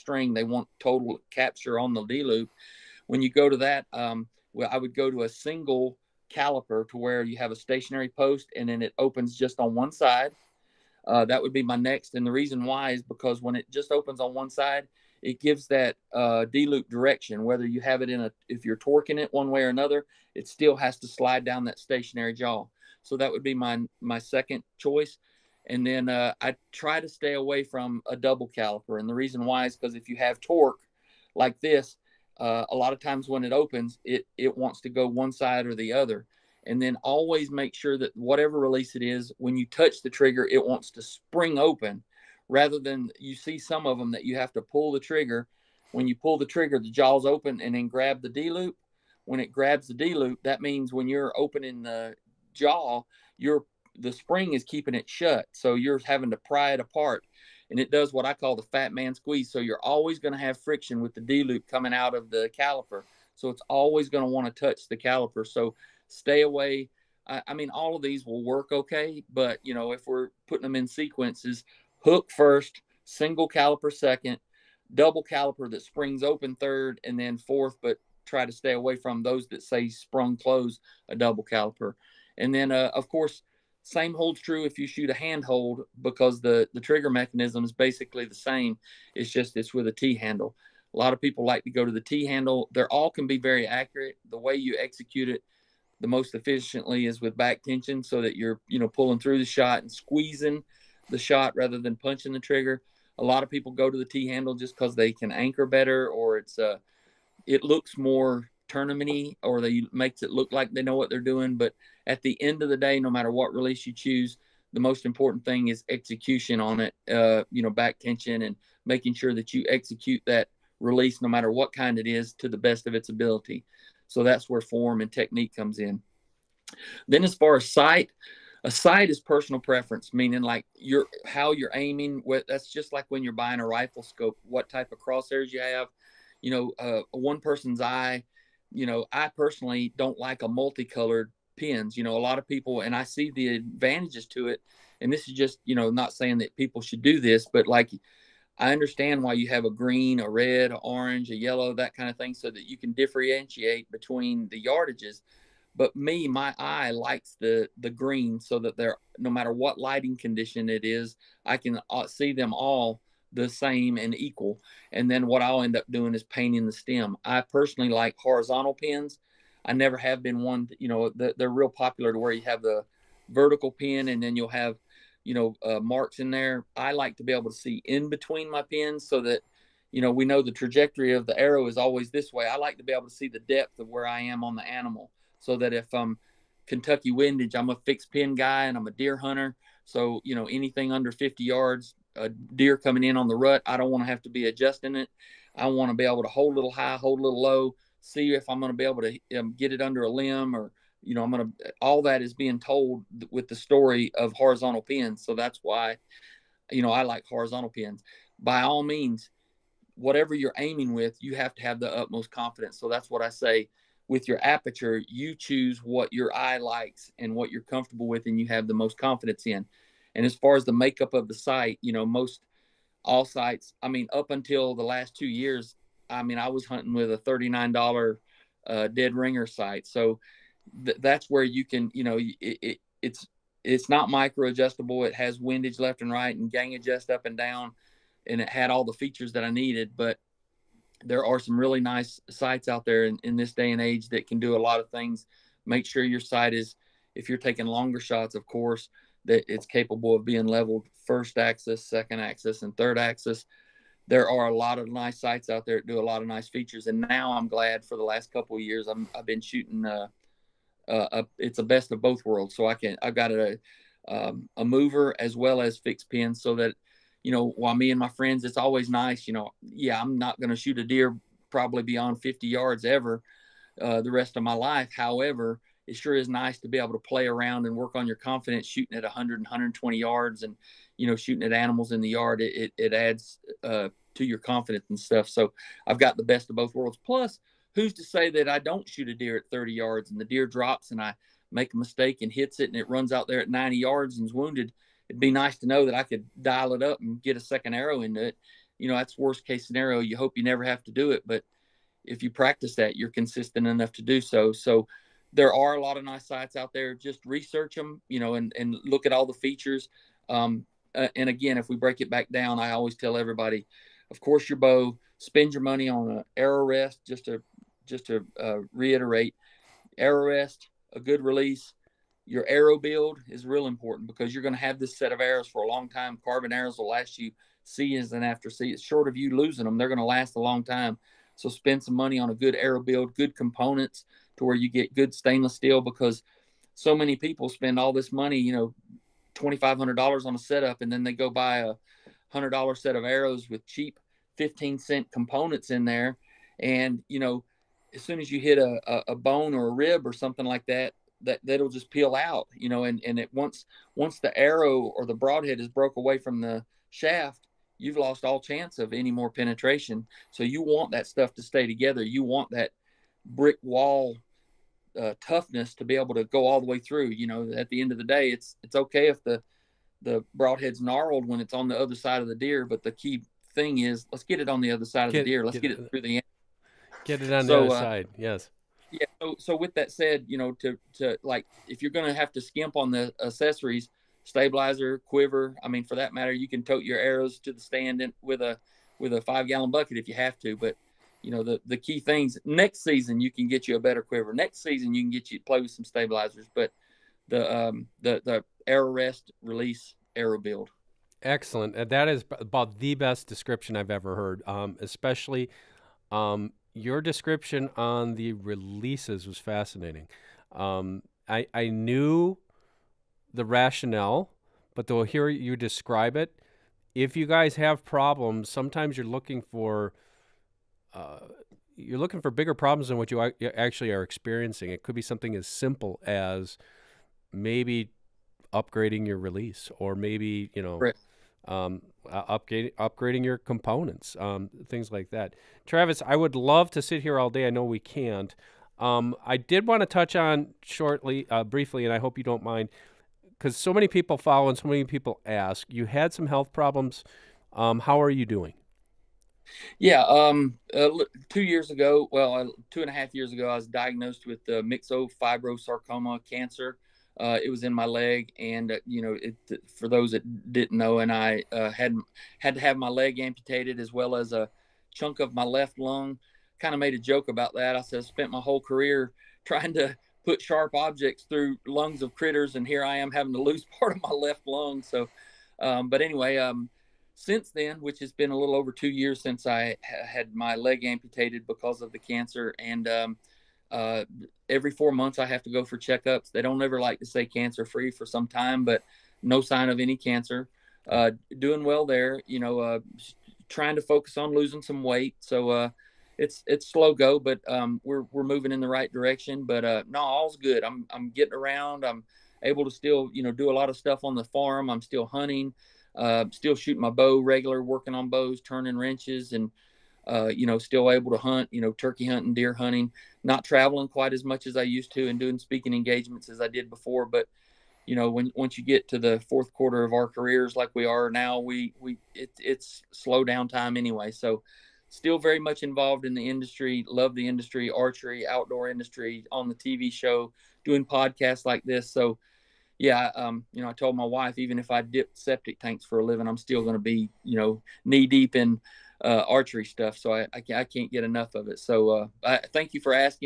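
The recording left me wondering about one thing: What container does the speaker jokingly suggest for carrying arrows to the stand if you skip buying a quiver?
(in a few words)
Five gallon bucket.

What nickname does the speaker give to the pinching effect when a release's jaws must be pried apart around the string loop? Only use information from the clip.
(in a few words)
The fat man squeeze.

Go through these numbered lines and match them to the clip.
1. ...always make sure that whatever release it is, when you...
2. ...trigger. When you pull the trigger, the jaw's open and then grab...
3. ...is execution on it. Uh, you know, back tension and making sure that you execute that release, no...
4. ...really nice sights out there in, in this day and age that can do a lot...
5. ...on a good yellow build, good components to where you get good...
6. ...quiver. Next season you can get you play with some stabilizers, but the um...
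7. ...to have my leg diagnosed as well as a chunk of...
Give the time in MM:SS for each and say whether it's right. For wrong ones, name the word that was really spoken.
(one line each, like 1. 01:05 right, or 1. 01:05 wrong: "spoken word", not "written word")
1. 00:37 right
2. 00:44 right
3. 01:55 right
4. 04:01 right
5. 05:32 wrong: "arrow", not "yellow"
6. 06:34 right
7. 07:42 wrong: "amputated", not "diagnosed".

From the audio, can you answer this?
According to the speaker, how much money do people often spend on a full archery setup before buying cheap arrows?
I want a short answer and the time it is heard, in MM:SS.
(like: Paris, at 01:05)
$2,500, at 05:39.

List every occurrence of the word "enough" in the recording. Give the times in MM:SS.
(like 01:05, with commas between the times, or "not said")
05:03, 09:01.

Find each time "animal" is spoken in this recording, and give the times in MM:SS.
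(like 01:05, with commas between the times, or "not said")
03:04, 04:41.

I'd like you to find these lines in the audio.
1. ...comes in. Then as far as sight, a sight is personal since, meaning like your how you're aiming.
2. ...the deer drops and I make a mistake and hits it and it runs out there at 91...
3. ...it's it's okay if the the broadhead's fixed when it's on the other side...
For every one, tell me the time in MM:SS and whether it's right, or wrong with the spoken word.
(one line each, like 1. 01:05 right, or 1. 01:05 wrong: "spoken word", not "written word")
1. 02:05 wrong: "preference", not "since"
2. 04:50 wrong: "90", not "91"
3. 06:08 wrong: "gnarled", not "fixed".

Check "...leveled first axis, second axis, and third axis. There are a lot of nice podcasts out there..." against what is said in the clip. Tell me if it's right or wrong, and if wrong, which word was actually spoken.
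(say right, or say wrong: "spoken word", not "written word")
wrong: "sights", not "podcasts".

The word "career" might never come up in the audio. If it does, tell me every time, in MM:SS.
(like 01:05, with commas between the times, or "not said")
07:48, 08:40.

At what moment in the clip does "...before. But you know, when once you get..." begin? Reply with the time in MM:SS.
08:36.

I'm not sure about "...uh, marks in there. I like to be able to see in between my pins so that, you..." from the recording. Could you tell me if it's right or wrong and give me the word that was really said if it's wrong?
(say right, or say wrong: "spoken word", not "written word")
right.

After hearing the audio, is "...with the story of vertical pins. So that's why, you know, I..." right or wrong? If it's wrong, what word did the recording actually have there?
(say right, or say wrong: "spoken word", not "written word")
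wrong: "horizontal", not "vertical".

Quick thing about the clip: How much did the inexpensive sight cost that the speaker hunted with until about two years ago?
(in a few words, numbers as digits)
$39.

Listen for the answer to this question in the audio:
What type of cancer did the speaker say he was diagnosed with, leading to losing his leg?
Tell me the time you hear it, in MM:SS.
07:34.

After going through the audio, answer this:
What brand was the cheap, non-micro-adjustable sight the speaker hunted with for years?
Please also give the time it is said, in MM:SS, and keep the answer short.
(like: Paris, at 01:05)
Dead Ringer, at 03:48.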